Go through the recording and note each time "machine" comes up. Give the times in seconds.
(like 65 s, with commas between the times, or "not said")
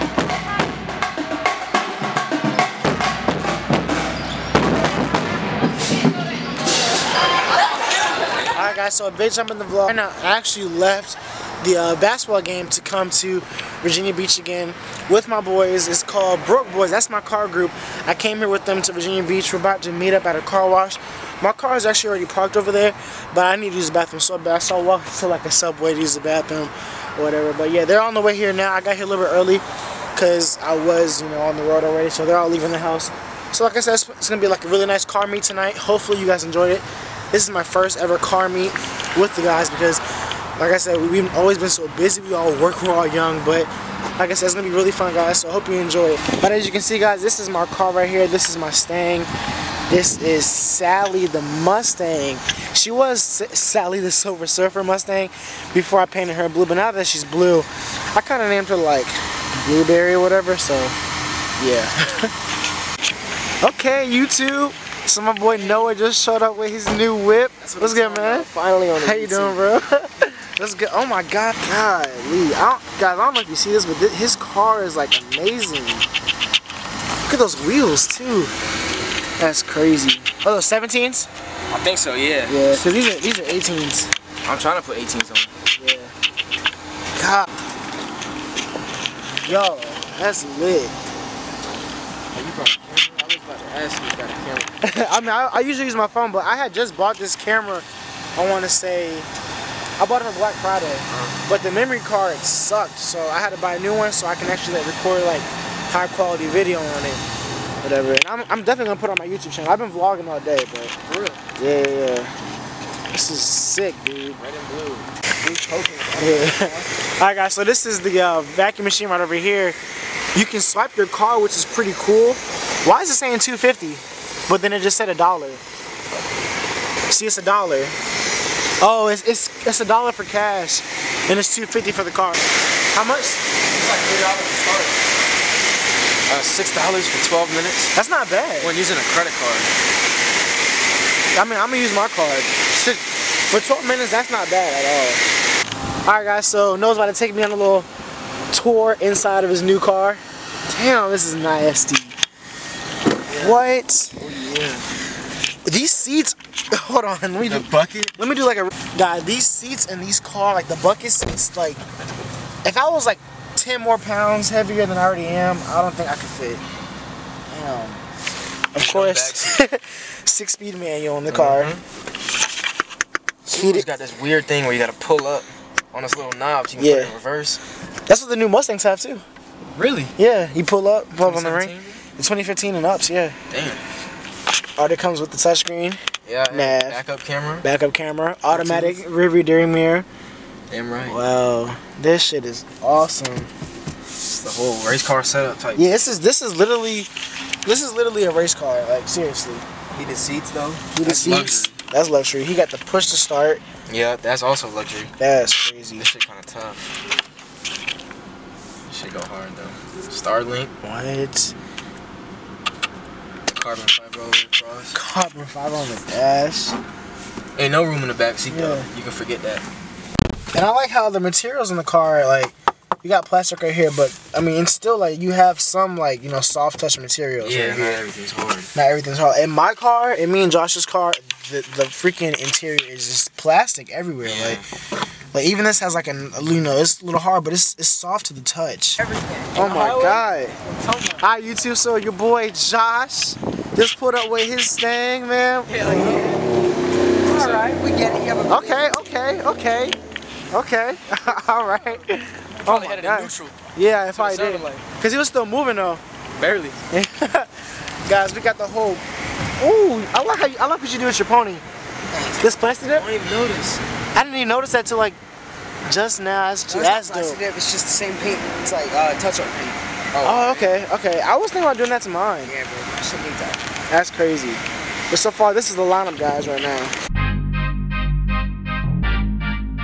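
118 s.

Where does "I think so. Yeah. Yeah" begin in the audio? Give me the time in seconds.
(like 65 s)
81 s.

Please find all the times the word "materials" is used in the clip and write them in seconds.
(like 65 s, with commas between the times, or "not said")
221 s, 226 s.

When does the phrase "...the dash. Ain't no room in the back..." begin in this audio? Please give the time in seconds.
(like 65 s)
215 s.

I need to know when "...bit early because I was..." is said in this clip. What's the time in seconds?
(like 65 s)
29 s.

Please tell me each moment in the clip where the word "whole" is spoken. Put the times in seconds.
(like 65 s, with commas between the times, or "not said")
194 s, 258 s.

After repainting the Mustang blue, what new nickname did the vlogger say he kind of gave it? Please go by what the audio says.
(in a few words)
Blueberry.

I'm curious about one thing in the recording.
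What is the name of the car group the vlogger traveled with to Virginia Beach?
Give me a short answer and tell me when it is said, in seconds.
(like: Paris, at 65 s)
Broke Boys, at 16 s.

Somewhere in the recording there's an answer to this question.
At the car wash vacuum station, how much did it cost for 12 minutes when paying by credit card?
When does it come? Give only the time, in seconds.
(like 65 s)
136 s.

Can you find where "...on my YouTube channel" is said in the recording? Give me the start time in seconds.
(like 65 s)
109 s.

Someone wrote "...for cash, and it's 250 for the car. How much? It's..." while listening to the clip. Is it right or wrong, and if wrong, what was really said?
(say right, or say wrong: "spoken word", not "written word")
right.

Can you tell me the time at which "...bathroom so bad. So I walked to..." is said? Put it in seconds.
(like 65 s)
23 s.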